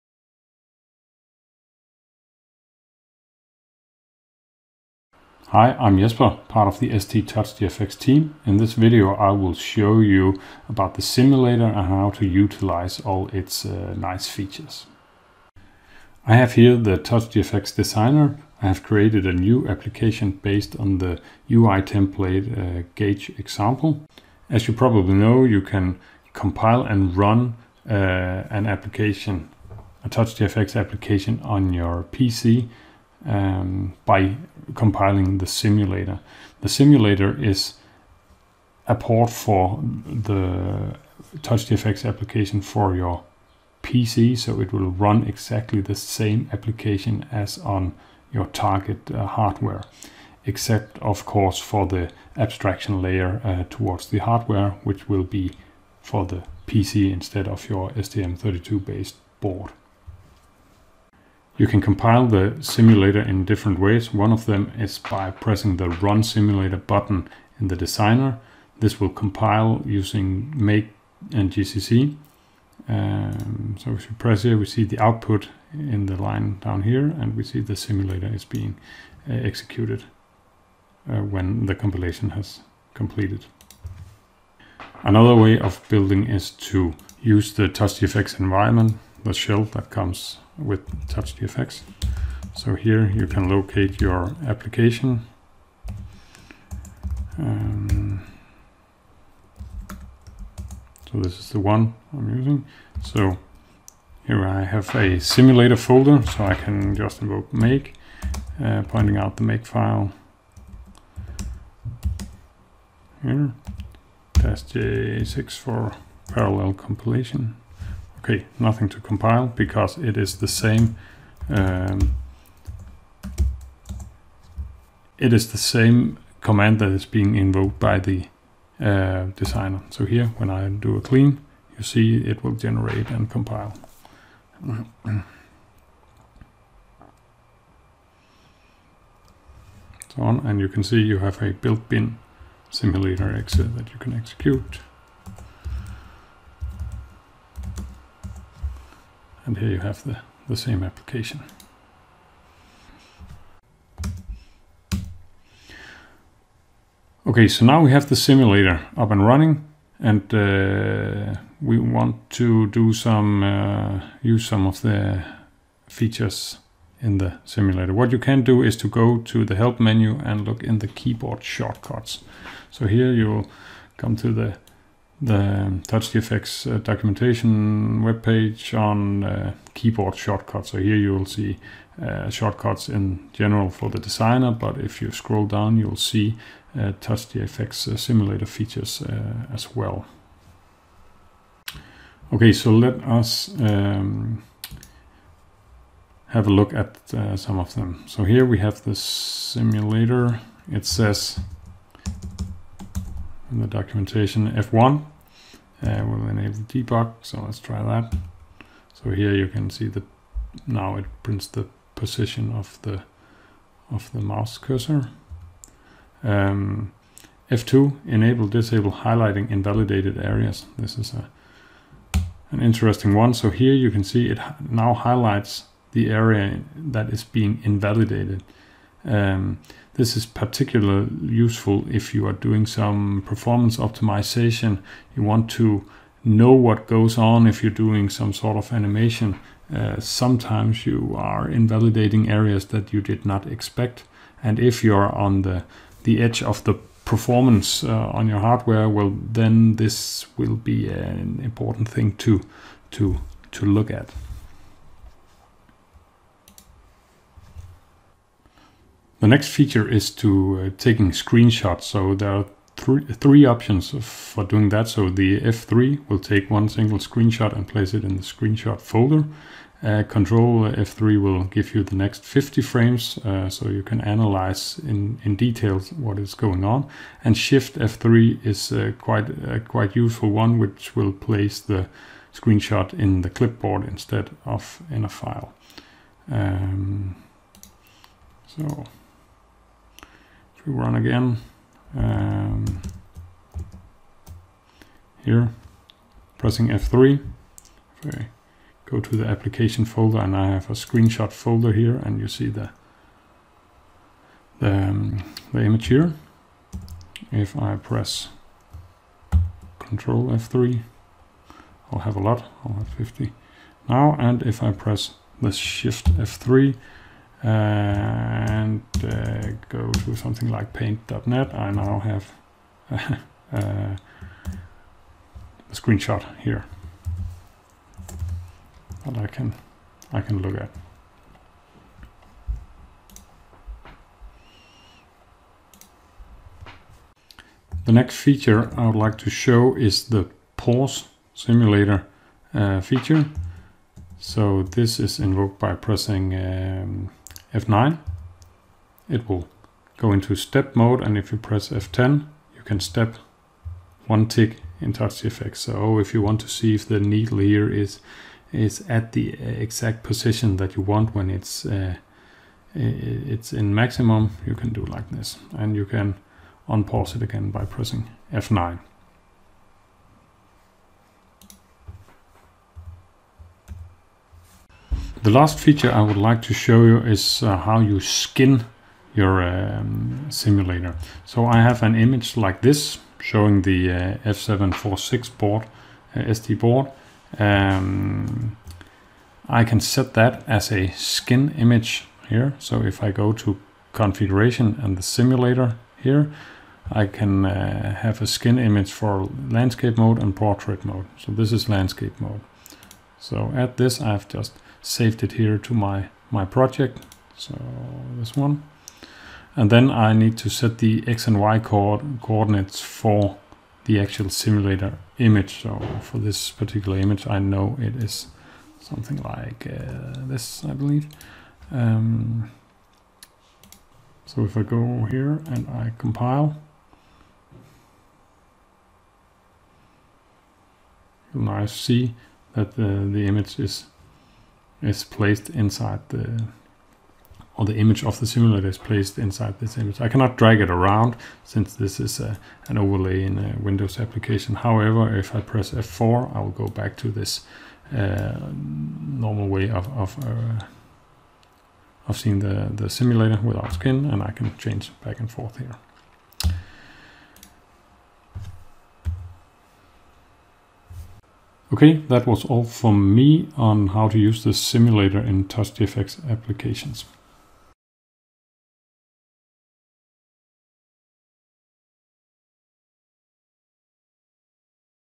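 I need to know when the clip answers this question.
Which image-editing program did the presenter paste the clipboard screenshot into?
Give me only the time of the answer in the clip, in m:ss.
5:20.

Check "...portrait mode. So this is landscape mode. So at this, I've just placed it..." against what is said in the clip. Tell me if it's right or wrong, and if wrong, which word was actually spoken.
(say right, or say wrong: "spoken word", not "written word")
wrong: "saved", not "placed".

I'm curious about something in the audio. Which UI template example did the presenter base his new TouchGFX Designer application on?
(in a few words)
Gauge example.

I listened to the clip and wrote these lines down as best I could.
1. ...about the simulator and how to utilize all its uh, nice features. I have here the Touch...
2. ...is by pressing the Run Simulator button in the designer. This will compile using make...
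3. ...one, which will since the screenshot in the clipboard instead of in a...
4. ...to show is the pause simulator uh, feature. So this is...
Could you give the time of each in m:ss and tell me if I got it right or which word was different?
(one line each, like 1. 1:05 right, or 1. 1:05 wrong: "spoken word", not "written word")
1. 0:10 right
2. 1:04 right
3. 4:40 wrong: "place", not "since"
4. 5:39 right.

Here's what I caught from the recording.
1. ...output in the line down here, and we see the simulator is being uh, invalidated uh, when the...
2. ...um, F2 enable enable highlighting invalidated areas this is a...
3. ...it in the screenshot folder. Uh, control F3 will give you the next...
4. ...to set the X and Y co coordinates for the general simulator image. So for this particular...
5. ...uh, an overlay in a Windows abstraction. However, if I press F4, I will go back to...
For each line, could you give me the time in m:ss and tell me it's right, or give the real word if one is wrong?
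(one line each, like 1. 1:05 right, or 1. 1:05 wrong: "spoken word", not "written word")
1. 1:14 wrong: "executed", not "invalidated"
2. 3:36 wrong: "disable", not "enable"
3. 4:27 right
4. 6:50 wrong: "actual", not "general"
5. 7:22 wrong: "application", not "abstraction".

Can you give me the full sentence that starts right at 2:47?
What you can do is to go to the help menu and look in the keyboard shortcuts.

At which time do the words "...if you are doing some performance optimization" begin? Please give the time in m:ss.
3:51.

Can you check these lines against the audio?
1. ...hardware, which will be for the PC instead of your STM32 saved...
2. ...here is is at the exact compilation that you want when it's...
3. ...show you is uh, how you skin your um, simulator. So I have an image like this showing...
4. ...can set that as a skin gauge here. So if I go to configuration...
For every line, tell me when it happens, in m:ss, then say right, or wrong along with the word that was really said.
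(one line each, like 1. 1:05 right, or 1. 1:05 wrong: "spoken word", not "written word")
1. 0:54 wrong: "based", not "saved"
2. 5:57 wrong: "position", not "compilation"
3. 6:16 right
4. 6:29 wrong: "image", not "gauge".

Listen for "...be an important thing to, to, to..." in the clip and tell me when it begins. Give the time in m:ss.
4:10.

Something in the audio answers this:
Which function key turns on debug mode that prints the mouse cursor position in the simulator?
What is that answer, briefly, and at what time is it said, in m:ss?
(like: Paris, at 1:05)
F1, at 3:24.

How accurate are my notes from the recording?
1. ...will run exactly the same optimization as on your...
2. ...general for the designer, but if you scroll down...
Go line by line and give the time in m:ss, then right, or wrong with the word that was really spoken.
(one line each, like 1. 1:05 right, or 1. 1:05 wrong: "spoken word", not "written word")
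1. 0:44 wrong: "application", not "optimization"
2. 3:03 right.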